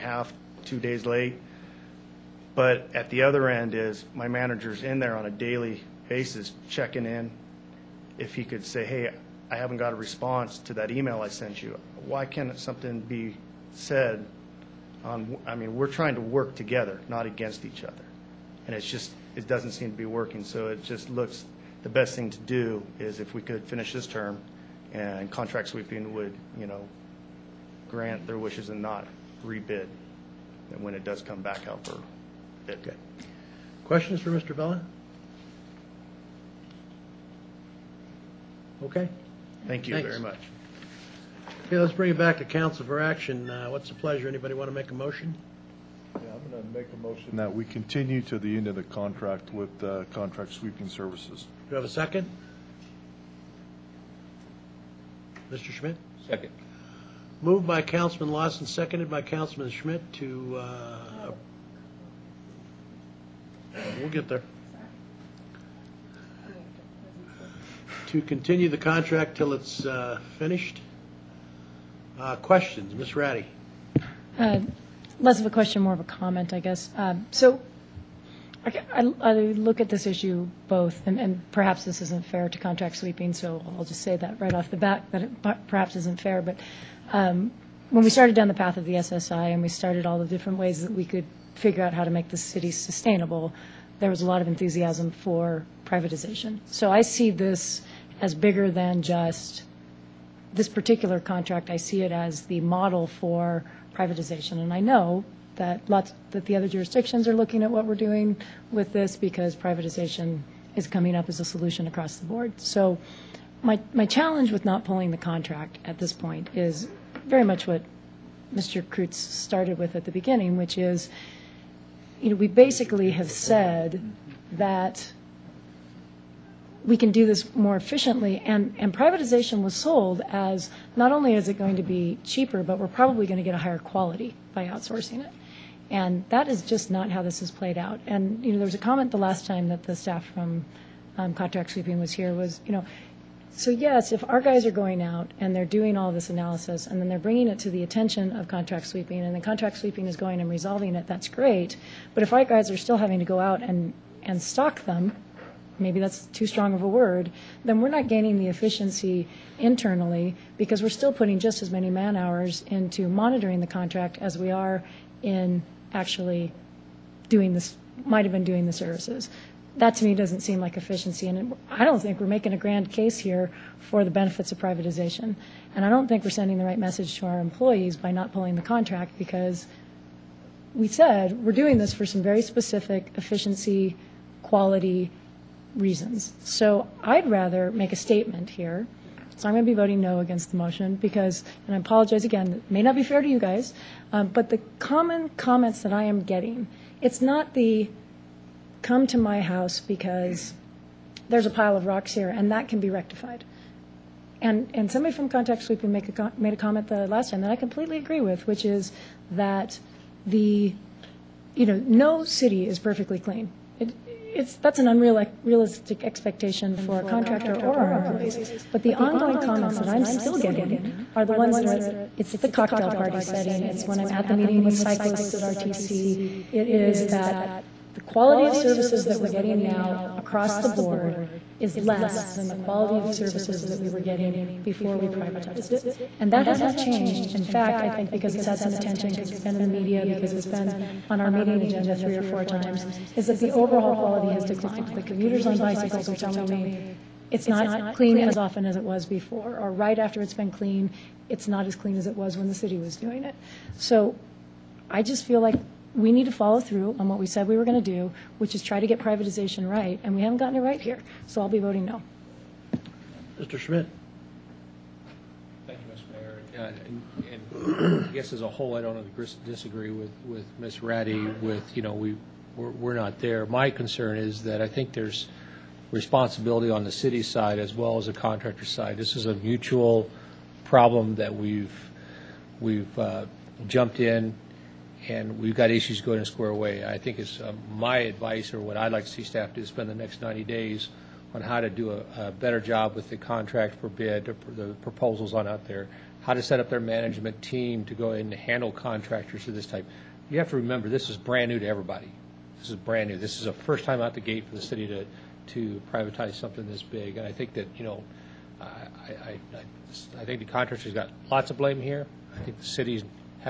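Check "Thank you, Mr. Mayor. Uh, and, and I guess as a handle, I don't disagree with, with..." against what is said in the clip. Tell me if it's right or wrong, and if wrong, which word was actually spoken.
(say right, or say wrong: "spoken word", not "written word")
wrong: "whole", not "handle".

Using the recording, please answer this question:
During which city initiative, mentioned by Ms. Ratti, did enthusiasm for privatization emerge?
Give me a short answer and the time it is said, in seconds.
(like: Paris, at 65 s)
SSI, at 88 s.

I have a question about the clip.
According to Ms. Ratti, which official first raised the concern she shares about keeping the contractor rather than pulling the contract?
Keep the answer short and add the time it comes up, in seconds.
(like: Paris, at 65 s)
Mr. Krutz, at 118 s.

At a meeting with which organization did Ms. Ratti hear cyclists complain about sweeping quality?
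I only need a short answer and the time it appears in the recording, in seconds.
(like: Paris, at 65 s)
RTC, at 225 s.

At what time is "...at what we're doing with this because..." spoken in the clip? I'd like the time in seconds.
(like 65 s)
107 s.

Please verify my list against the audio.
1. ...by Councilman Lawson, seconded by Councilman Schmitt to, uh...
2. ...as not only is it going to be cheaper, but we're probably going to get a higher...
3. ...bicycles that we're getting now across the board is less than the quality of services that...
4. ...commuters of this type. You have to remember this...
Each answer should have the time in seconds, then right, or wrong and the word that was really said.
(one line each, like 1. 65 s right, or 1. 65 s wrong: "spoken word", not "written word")
1. 57 s right
2. 130 s right
3. 228 s wrong: "services", not "bicycles"
4. 298 s wrong: "contractors", not "commuters".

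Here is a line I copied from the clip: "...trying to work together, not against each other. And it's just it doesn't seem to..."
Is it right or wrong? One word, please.
right.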